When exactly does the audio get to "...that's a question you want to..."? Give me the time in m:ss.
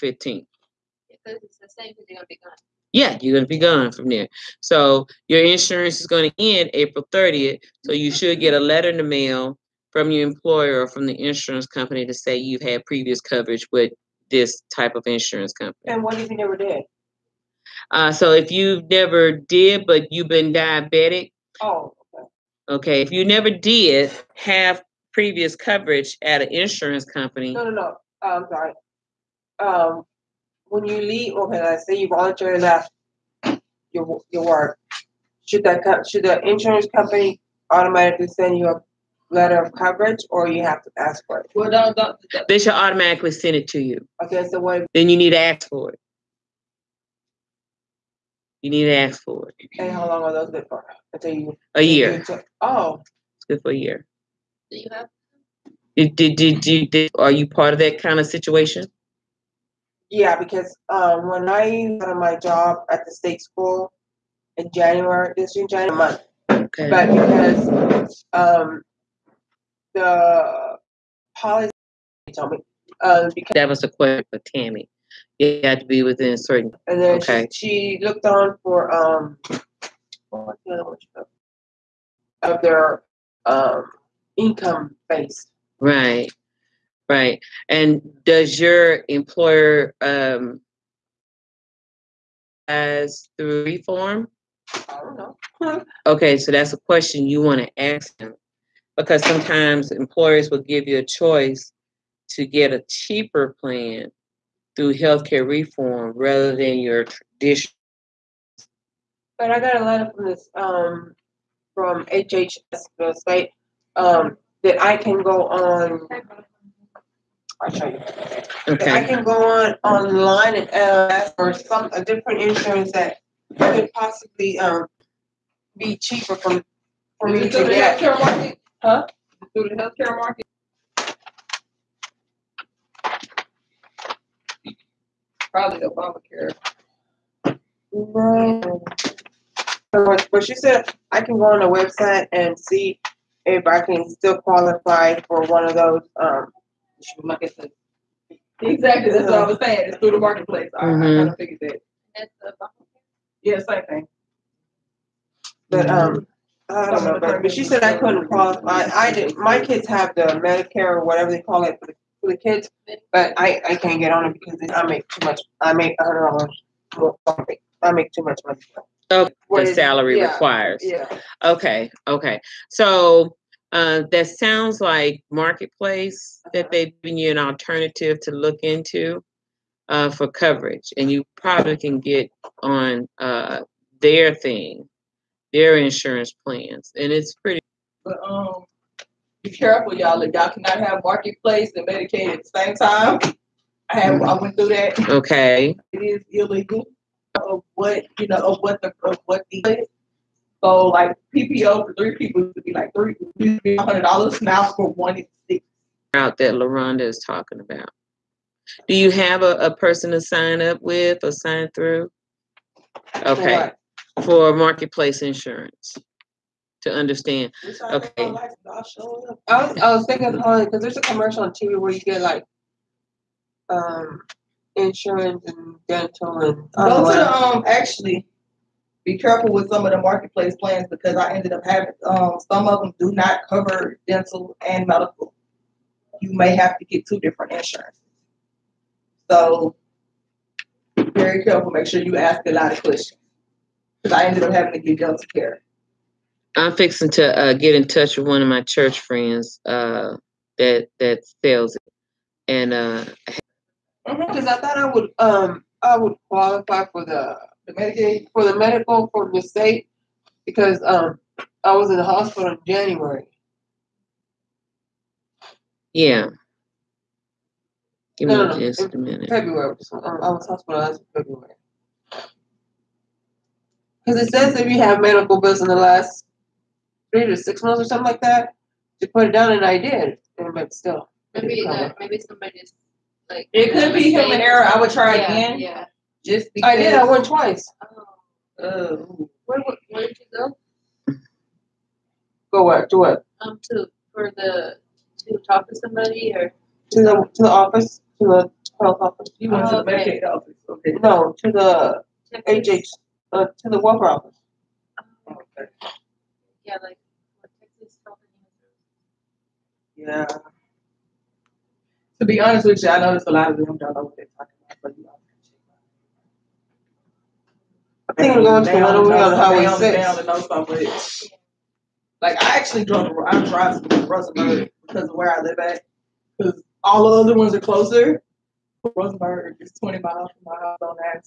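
1:36.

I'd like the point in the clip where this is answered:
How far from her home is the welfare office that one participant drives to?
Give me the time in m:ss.
5:29.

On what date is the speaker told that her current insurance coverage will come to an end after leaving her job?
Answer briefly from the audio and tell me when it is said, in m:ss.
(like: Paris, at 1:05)
April 30th, at 0:06.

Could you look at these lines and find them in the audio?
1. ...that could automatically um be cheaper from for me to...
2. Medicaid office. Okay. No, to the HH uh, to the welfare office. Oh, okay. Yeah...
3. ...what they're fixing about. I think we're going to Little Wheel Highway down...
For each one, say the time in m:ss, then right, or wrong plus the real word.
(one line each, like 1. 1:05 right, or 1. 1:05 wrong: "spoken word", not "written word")
1. 2:02 wrong: "possibly", not "automatically"
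2. 5:00 right
3. 5:14 wrong: "talking", not "fixing".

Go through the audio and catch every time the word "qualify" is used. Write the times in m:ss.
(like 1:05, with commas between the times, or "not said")
2:24, 2:38, 4:16.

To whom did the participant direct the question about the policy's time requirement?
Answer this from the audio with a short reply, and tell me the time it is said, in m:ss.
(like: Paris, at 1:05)
Tammy, at 1:14.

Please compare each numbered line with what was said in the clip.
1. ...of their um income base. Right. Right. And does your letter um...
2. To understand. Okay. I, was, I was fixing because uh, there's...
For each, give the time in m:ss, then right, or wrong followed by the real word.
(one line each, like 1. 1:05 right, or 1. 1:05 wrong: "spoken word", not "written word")
1. 1:22 wrong: "employer", not "letter"
2. 3:36 wrong: "thinking", not "fixing".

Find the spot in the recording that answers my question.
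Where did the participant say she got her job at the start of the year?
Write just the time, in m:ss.
1:03.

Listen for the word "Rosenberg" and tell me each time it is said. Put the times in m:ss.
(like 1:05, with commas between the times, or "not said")
5:24, 5:28.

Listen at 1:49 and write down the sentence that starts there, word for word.
But I got a letter from this um, from HHS website um, that I can go on I'll show you.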